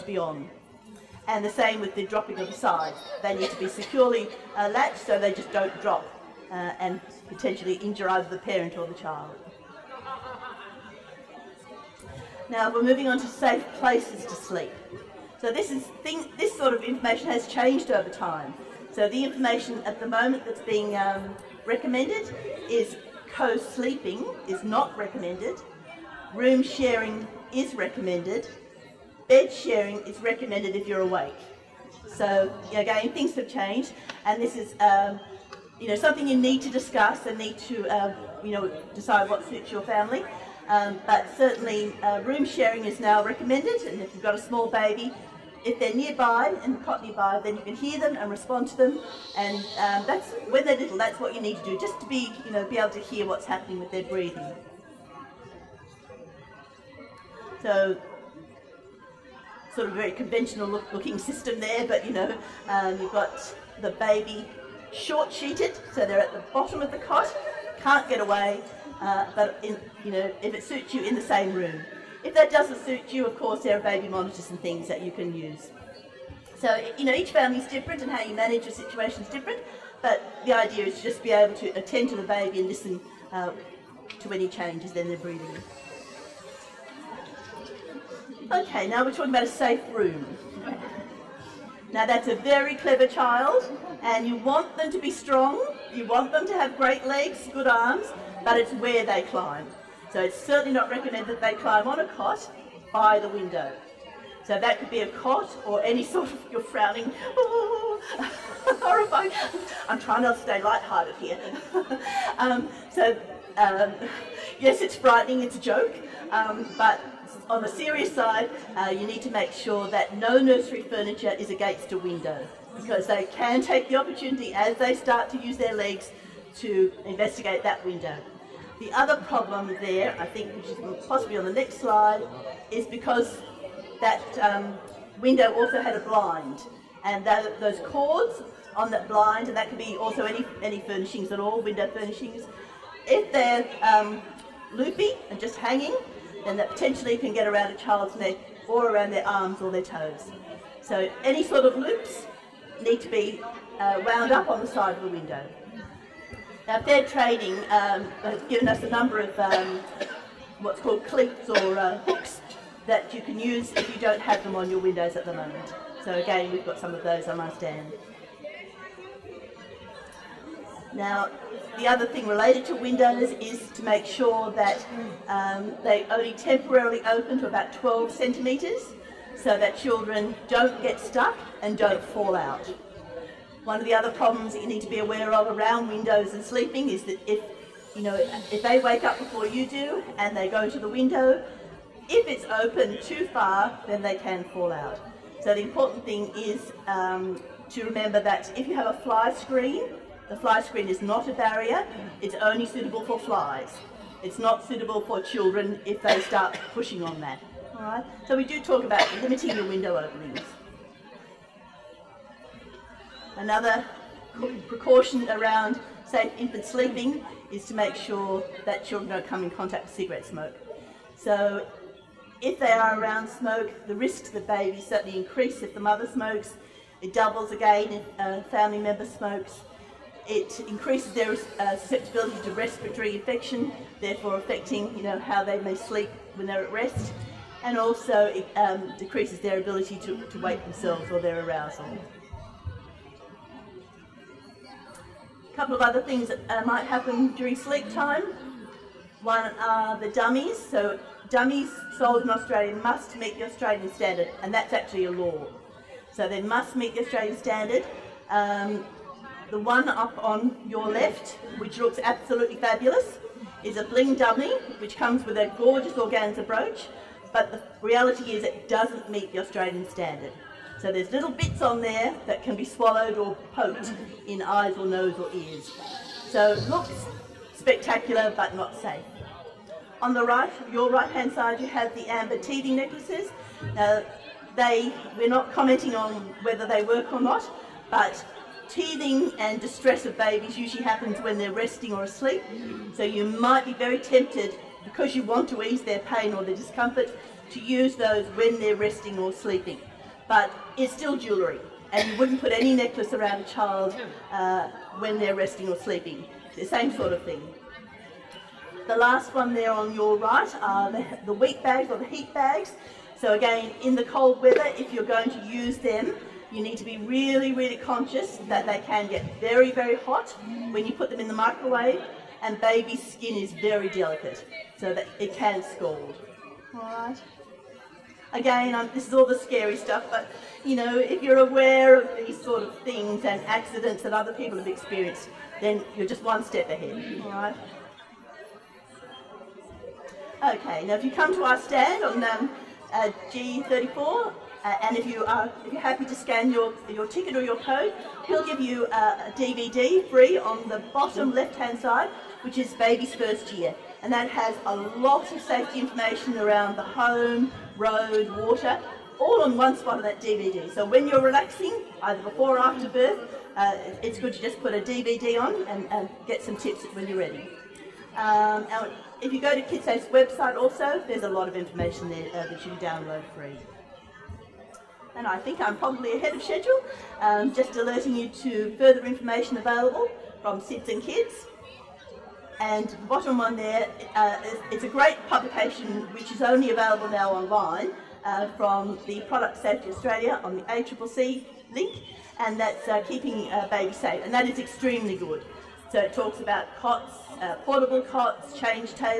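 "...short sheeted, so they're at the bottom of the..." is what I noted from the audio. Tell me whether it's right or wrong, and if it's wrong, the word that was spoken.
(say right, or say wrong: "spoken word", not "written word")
right.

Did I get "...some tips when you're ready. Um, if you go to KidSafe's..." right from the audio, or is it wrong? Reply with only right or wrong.
right.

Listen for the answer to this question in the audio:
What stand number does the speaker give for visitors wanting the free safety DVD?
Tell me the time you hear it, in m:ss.
5:43.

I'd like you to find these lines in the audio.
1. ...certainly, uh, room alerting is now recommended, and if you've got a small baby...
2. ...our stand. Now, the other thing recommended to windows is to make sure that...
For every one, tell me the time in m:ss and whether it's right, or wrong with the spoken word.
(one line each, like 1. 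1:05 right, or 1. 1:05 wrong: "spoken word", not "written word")
1. 0:41 wrong: "sharing", not "alerting"
2. 2:47 wrong: "related", not "recommended".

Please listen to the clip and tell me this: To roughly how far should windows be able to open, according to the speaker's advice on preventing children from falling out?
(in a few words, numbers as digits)
12 centimetres.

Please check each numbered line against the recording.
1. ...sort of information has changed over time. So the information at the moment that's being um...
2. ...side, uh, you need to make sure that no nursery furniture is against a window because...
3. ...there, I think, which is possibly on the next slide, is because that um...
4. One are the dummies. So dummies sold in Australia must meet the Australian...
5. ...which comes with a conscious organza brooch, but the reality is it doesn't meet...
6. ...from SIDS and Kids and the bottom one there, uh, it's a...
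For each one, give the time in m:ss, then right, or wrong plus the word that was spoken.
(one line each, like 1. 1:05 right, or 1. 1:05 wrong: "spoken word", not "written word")
1. 0:16 right
2. 1:58 right
3. 2:09 right
4. 4:09 right
5. 4:24 wrong: "gorgeous", not "conscious"
6. 6:20 right.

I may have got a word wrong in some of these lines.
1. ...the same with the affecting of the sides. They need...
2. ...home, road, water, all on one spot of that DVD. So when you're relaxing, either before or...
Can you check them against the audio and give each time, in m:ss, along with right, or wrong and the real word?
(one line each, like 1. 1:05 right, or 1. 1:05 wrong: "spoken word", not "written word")
1. 0:01 wrong: "dropping", not "affecting"
2. 5:56 right.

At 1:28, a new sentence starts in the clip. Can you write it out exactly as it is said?
Okay, now we're talking about a safe room.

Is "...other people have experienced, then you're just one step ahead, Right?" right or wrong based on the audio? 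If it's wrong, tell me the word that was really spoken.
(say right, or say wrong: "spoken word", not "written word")
right.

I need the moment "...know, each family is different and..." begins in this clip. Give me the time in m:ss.
1:17.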